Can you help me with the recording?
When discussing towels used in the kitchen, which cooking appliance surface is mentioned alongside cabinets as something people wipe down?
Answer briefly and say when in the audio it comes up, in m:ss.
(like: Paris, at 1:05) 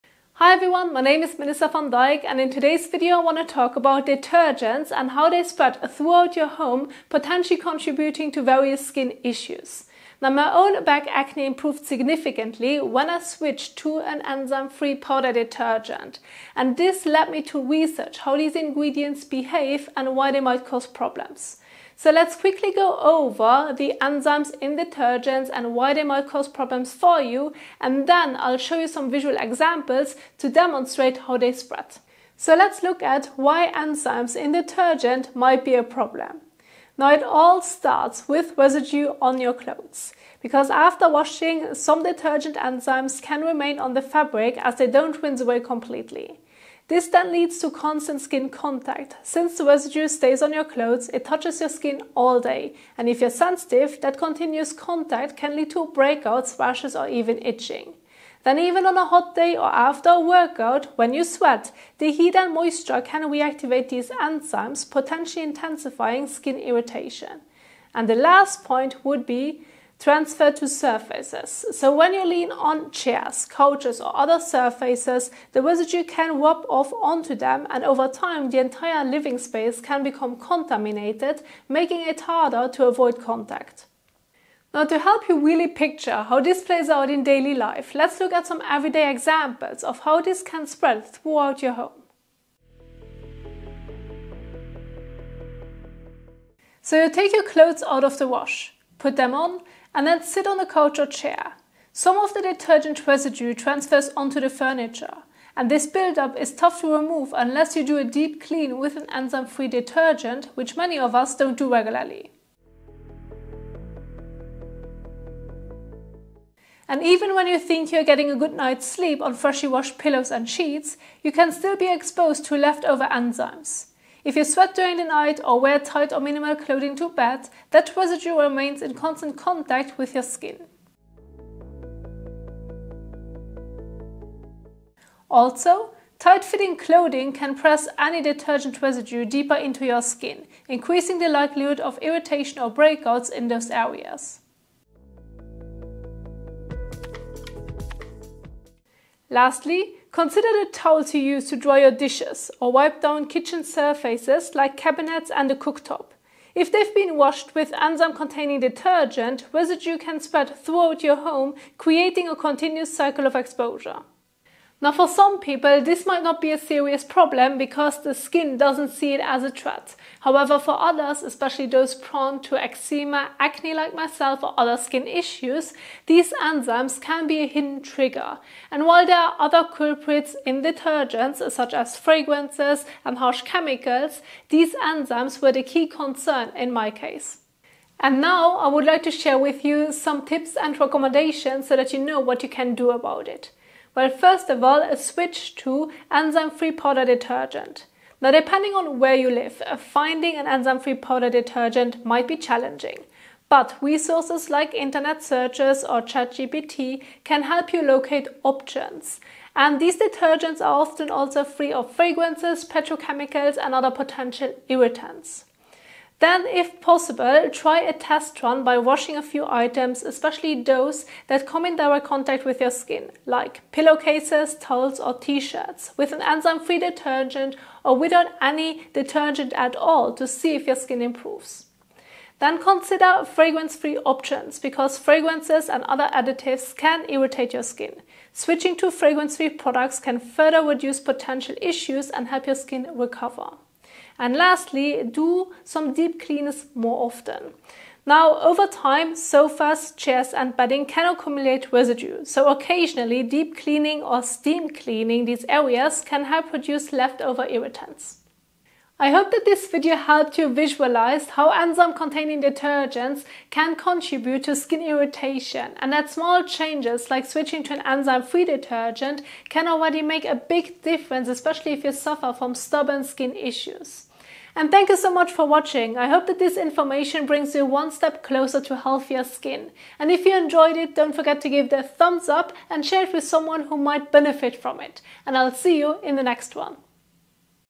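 cooktop, at 2:35.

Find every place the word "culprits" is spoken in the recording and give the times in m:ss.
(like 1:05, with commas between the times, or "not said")
2:59.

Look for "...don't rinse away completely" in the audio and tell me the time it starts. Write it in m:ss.
0:44.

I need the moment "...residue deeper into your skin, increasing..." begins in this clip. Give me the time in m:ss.
2:18.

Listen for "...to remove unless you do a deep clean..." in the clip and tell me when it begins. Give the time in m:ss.
1:46.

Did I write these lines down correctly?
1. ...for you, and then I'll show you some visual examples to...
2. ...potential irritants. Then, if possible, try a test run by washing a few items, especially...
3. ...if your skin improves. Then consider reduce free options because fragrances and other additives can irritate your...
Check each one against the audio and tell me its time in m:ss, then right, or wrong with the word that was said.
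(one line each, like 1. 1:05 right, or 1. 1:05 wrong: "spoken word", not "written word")
1. 0:26 right
2. 3:33 right
3. 3:50 wrong: "fragrance", not "reduce".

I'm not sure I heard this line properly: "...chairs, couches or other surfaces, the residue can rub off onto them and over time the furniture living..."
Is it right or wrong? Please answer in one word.
wrong.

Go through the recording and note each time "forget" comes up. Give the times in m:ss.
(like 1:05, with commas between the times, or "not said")
4:41.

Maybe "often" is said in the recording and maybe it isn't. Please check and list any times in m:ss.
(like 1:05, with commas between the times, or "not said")
3:30, 4:07.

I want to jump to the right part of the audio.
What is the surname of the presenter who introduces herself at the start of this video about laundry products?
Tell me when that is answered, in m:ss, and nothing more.
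0:01.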